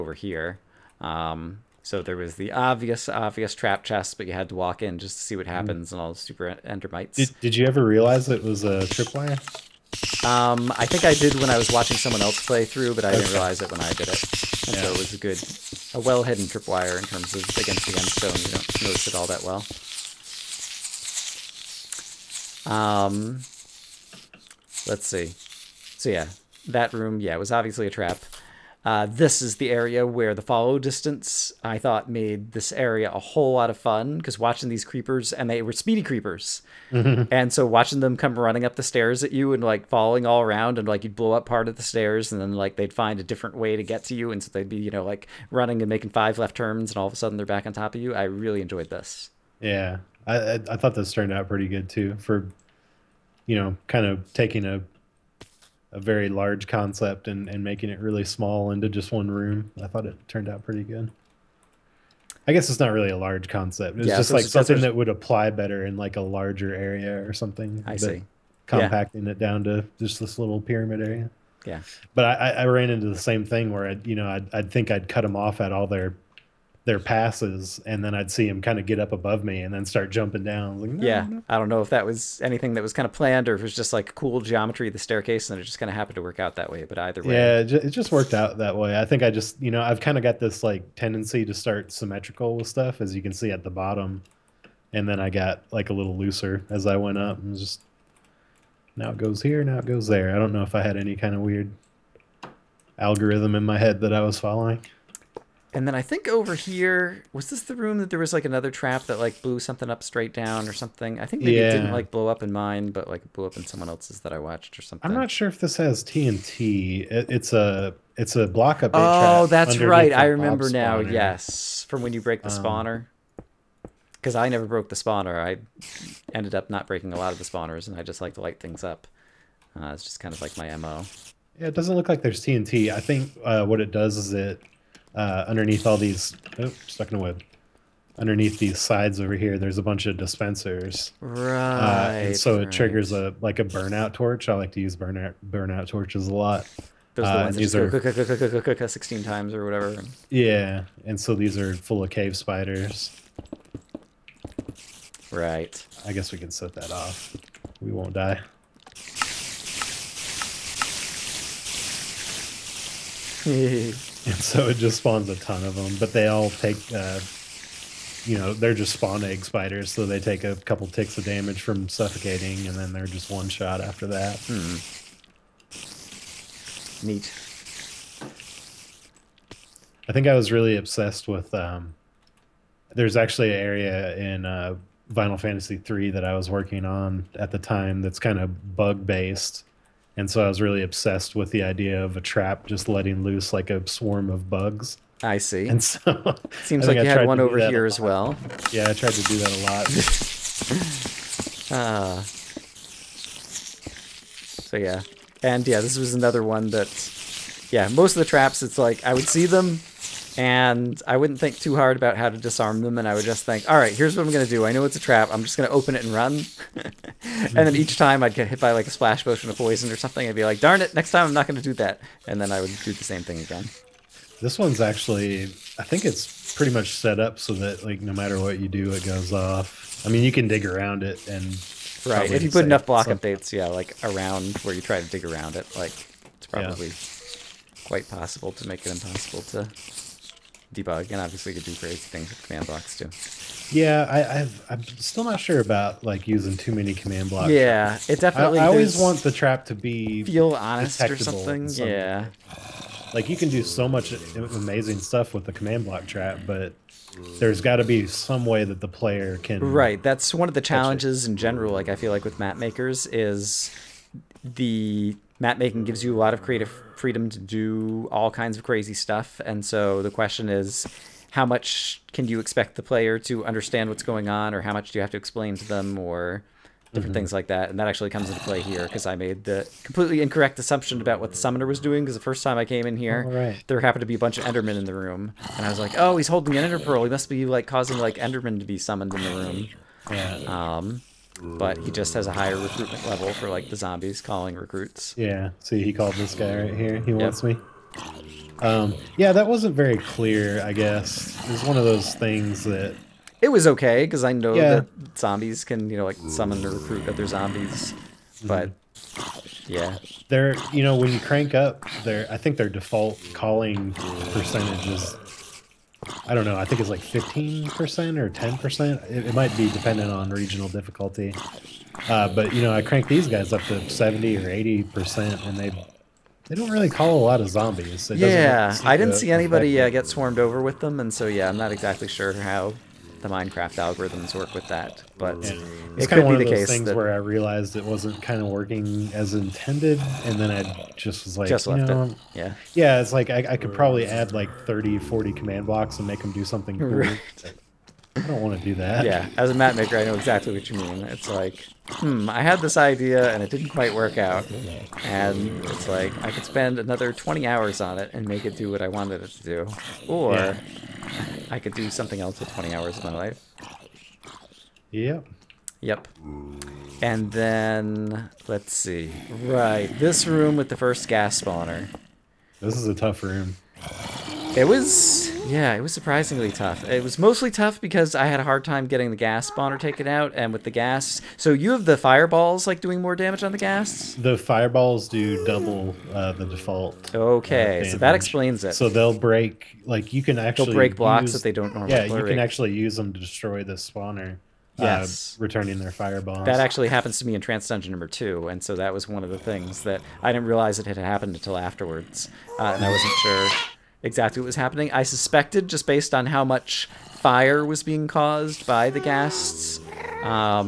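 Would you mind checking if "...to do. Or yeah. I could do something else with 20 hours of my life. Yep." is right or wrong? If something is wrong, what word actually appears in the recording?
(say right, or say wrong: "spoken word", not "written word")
right.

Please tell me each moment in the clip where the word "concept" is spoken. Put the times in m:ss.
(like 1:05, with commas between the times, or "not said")
0:56, 1:03.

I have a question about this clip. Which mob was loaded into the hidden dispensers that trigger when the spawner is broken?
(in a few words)
cave spiders.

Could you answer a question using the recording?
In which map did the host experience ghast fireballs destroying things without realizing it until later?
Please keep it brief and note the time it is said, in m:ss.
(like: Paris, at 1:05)
Trance Dungeon number two, at 6:37.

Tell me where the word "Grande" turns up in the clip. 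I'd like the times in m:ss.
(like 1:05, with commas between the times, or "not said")
not said.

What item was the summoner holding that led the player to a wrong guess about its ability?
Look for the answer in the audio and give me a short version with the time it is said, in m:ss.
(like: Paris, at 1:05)
Ender Pearl, at 4:46.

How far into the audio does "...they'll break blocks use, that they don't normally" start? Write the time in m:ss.
6:30.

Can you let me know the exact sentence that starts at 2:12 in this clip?
I think uh, what it does is it uh, underneath all these, oh, stuck in a wood.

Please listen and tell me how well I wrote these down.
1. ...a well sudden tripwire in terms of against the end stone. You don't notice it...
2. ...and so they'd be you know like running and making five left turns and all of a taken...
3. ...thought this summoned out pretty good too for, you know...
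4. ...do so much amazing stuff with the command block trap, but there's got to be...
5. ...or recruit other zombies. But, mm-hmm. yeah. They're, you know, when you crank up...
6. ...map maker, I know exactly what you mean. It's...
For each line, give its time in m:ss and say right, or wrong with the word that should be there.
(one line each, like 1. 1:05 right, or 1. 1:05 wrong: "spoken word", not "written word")
1. 0:15 wrong: "hidden", not "sudden"
2. 0:44 wrong: "sudden", not "taken"
3. 0:50 wrong: "turned", not "summoned"
4. 4:13 right
5. 5:06 right
6. 5:49 right.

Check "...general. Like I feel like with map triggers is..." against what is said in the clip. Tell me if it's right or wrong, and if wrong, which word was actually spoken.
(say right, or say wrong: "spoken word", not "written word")
wrong: "makers", not "triggers".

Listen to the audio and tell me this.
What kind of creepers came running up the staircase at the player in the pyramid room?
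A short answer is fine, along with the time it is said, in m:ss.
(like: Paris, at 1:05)
speedy creepers, at 0:35.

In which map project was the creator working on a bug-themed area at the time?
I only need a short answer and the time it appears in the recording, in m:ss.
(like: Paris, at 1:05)
Vinyl Fantasy 3, at 3:05.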